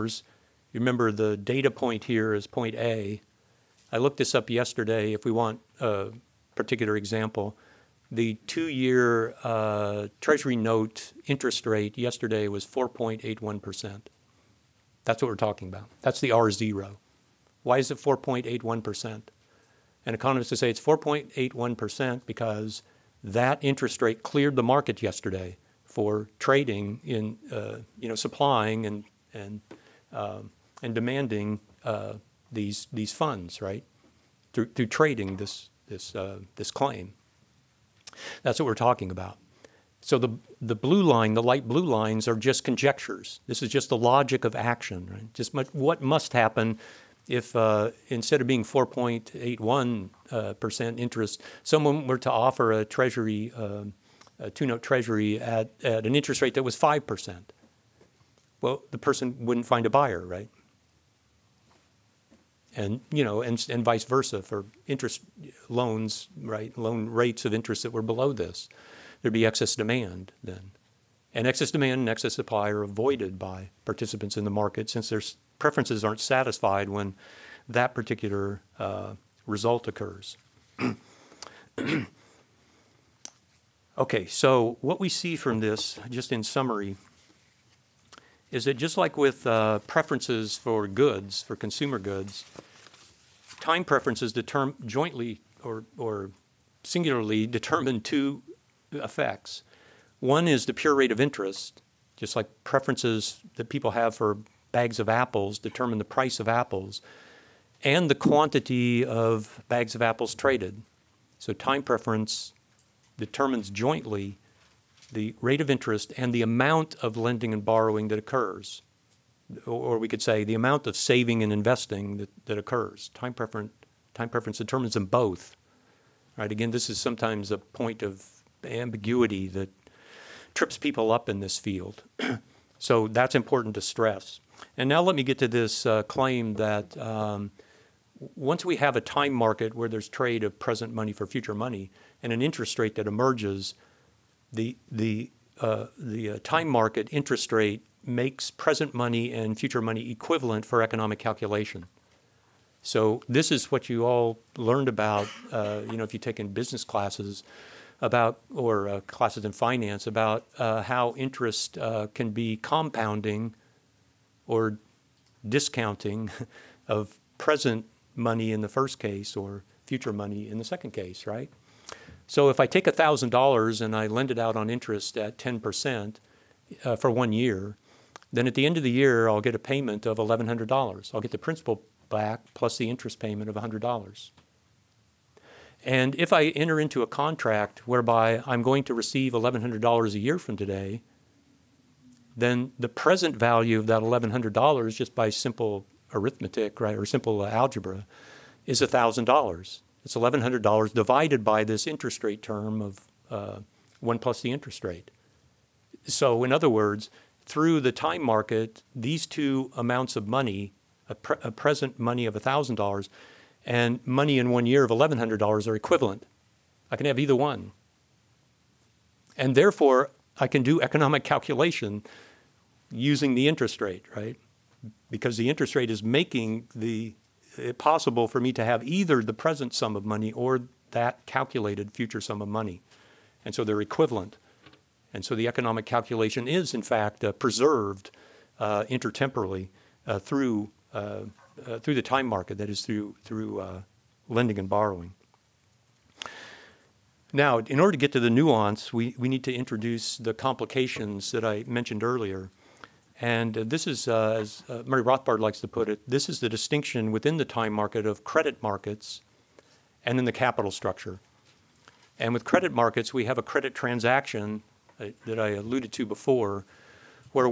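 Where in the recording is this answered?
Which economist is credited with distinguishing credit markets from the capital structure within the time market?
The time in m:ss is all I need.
4:14.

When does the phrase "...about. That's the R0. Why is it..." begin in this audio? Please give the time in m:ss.
0:15.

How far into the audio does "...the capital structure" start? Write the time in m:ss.
4:20.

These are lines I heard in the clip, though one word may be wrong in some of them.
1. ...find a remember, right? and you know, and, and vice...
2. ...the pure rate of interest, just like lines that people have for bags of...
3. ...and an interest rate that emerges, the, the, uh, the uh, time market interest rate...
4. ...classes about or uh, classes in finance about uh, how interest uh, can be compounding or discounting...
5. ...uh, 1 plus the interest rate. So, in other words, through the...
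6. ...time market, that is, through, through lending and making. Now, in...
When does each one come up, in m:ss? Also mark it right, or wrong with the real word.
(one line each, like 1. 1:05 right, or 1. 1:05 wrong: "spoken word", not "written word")
1. 0:59 wrong: "buyer", not "remember"
2. 1:40 wrong: "preferences", not "lines"
3. 2:22 right
4. 2:36 right
5. 3:23 right
6. 4:02 wrong: "borrowing", not "making".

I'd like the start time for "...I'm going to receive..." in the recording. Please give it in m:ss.
3:08.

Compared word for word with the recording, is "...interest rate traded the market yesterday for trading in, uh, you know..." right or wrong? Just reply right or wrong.
wrong.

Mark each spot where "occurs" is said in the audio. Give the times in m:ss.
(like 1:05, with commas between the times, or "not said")
1:19, 1:58, 2:02.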